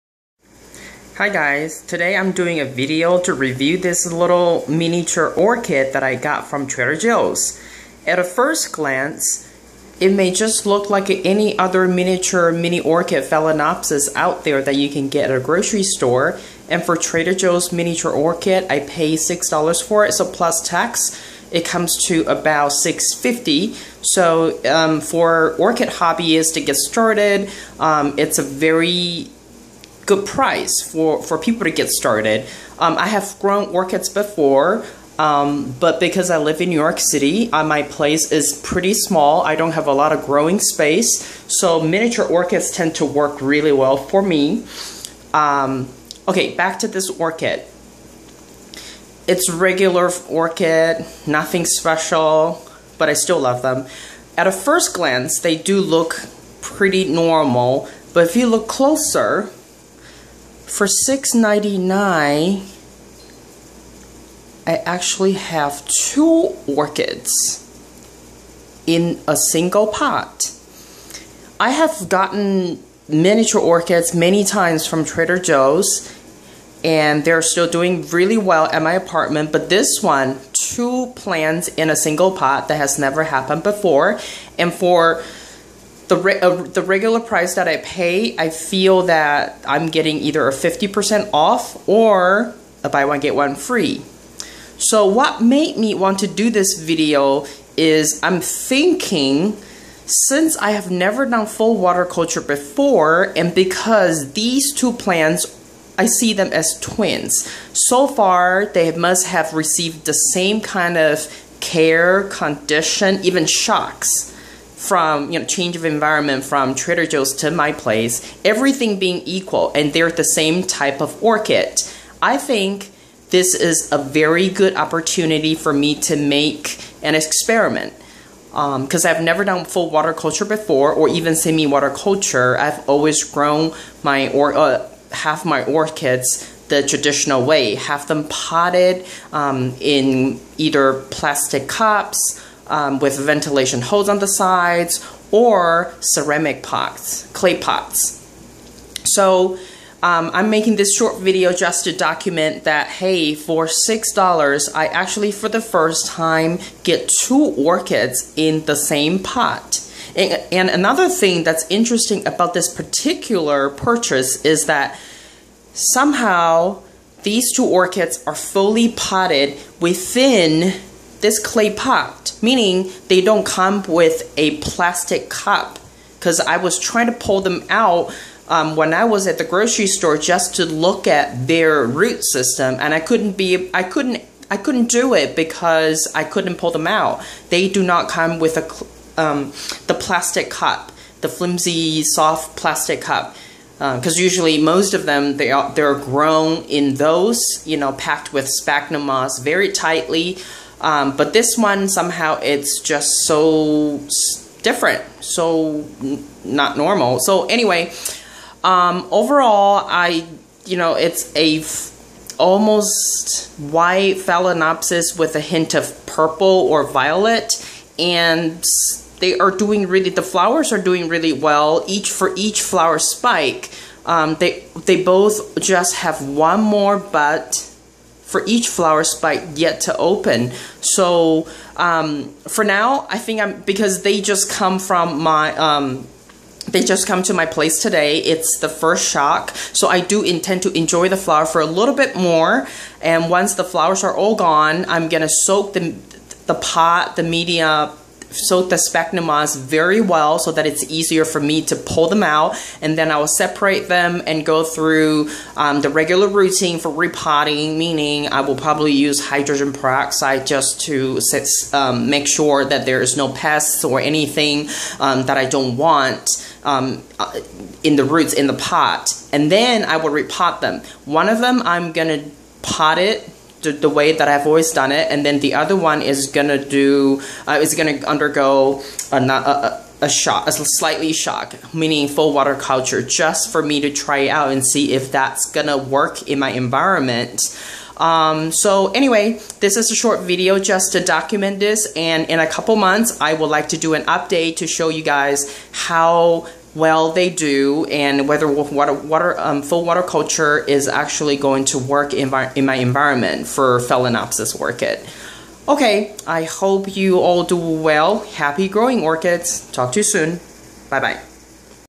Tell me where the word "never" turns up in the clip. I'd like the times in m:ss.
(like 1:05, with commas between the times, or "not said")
1:22, 1:40, 2:09.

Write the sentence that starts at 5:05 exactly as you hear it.
Okay, I hope you all do well.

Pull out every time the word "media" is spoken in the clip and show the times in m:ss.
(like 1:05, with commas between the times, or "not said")
4:07.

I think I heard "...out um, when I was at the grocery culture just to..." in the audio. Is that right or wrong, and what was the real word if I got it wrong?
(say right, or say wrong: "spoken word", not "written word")
wrong: "store", not "culture".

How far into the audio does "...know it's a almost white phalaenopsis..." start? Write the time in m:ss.
3:30.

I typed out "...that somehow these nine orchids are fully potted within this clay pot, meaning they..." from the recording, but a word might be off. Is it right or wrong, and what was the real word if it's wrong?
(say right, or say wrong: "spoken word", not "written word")
wrong: "two", not "nine".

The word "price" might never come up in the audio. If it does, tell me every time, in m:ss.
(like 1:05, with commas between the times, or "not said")
0:30, 1:27.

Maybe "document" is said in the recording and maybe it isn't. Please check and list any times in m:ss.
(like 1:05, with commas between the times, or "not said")
2:31, 4:51.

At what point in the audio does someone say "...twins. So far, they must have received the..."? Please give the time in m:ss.
1:46.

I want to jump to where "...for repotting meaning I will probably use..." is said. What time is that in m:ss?
4:16.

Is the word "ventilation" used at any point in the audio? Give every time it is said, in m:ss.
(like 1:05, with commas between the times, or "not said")
2:23.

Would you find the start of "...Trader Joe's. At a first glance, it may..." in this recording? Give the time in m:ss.
0:06.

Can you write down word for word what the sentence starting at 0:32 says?
Um, I have grown orchids before, um, but because I live in New York City, uh, my place is pretty small.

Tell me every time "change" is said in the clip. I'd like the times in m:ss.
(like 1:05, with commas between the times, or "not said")
1:55.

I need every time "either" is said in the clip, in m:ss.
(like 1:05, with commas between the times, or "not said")
1:30, 2:20.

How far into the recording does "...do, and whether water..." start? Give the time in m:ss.
4:57.